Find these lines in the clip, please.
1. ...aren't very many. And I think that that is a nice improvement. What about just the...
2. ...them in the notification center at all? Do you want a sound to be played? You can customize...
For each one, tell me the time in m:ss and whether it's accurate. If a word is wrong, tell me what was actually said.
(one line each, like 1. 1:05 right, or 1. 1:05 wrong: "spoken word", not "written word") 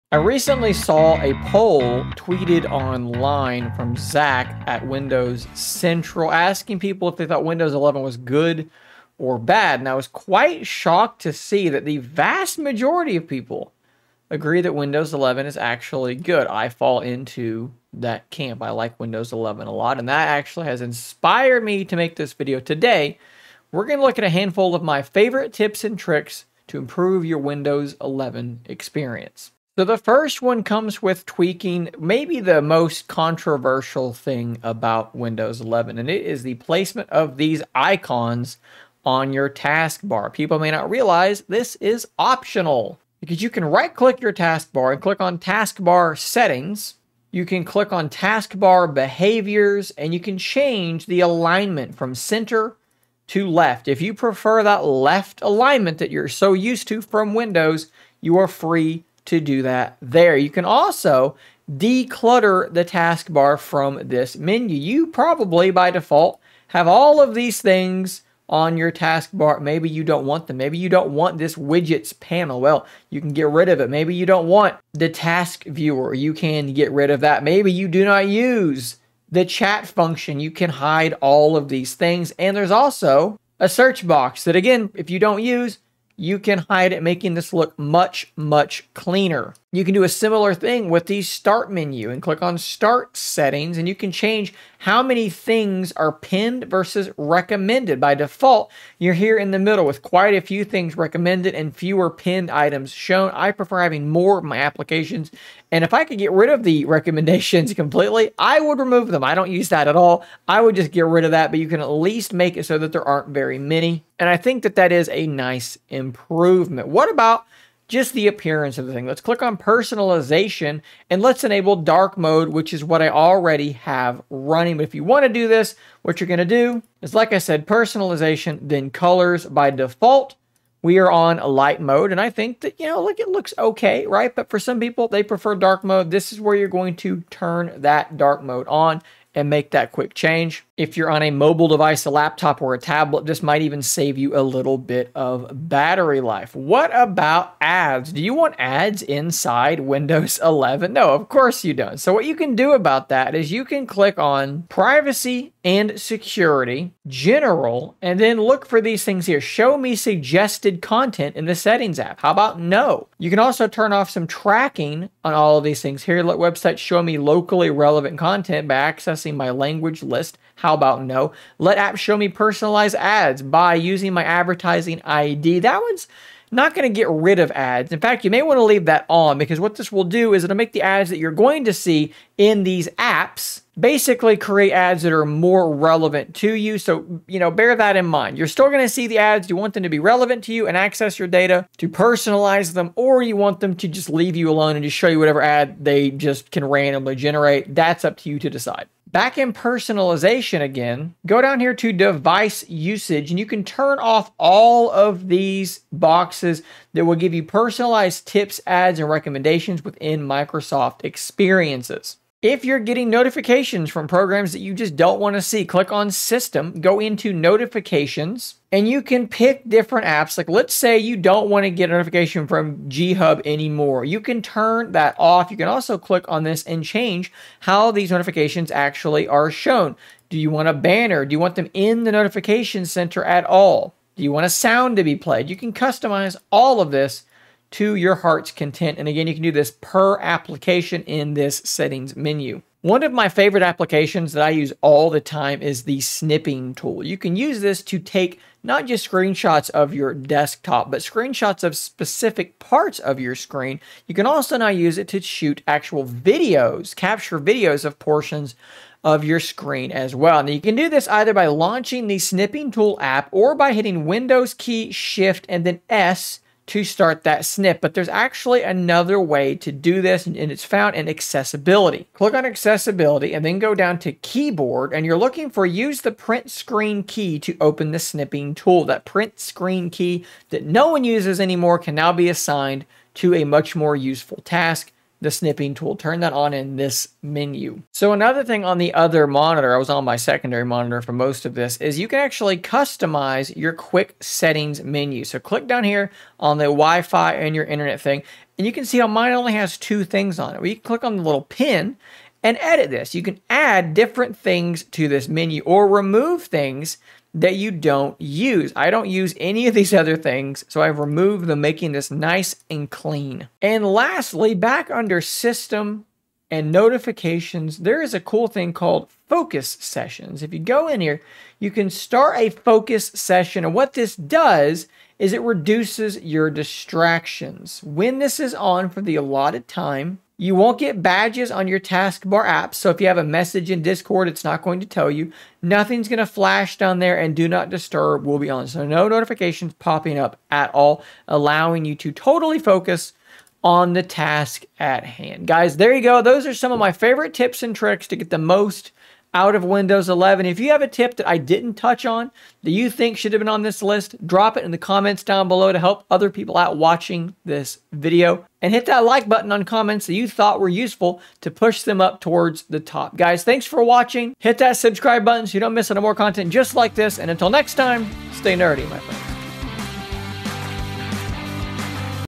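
1. 1:53 right
2. 3:51 right.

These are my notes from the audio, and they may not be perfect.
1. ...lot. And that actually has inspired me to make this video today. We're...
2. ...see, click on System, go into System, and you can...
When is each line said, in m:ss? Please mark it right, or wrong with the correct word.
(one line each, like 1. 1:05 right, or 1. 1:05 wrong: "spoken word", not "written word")
1. 0:19 right
2. 3:35 wrong: "Notifications", not "System".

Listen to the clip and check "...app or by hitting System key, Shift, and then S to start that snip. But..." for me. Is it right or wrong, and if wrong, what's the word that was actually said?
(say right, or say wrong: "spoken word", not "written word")
wrong: "Windows", not "System".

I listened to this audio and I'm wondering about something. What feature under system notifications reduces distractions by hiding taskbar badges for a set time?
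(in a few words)
Focus Sessions.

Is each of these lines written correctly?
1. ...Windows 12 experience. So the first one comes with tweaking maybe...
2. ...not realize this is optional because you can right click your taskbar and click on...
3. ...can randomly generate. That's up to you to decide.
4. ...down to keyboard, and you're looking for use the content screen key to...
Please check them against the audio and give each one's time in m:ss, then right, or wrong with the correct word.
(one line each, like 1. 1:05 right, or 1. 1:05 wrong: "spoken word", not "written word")
1. 0:27 wrong: "11", not "12"
2. 0:40 right
3. 3:16 right
4. 4:33 wrong: "print", not "content".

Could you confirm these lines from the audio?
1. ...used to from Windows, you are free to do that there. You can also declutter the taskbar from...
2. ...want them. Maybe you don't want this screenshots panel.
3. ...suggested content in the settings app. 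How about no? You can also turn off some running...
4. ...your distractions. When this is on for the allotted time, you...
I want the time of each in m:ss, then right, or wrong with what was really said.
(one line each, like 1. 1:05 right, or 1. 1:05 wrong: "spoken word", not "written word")
1. 0:56 right
2. 1:10 wrong: "widgets", not "screenshots"
3. 2:39 wrong: "tracking", not "running"
4. 5:26 right.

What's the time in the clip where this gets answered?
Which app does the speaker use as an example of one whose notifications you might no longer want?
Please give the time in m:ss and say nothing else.
3:42.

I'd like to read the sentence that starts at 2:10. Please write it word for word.
We are on light mode, and I think that, you know, look, it looks okay, right?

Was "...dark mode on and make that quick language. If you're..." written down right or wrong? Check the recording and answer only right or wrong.
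wrong.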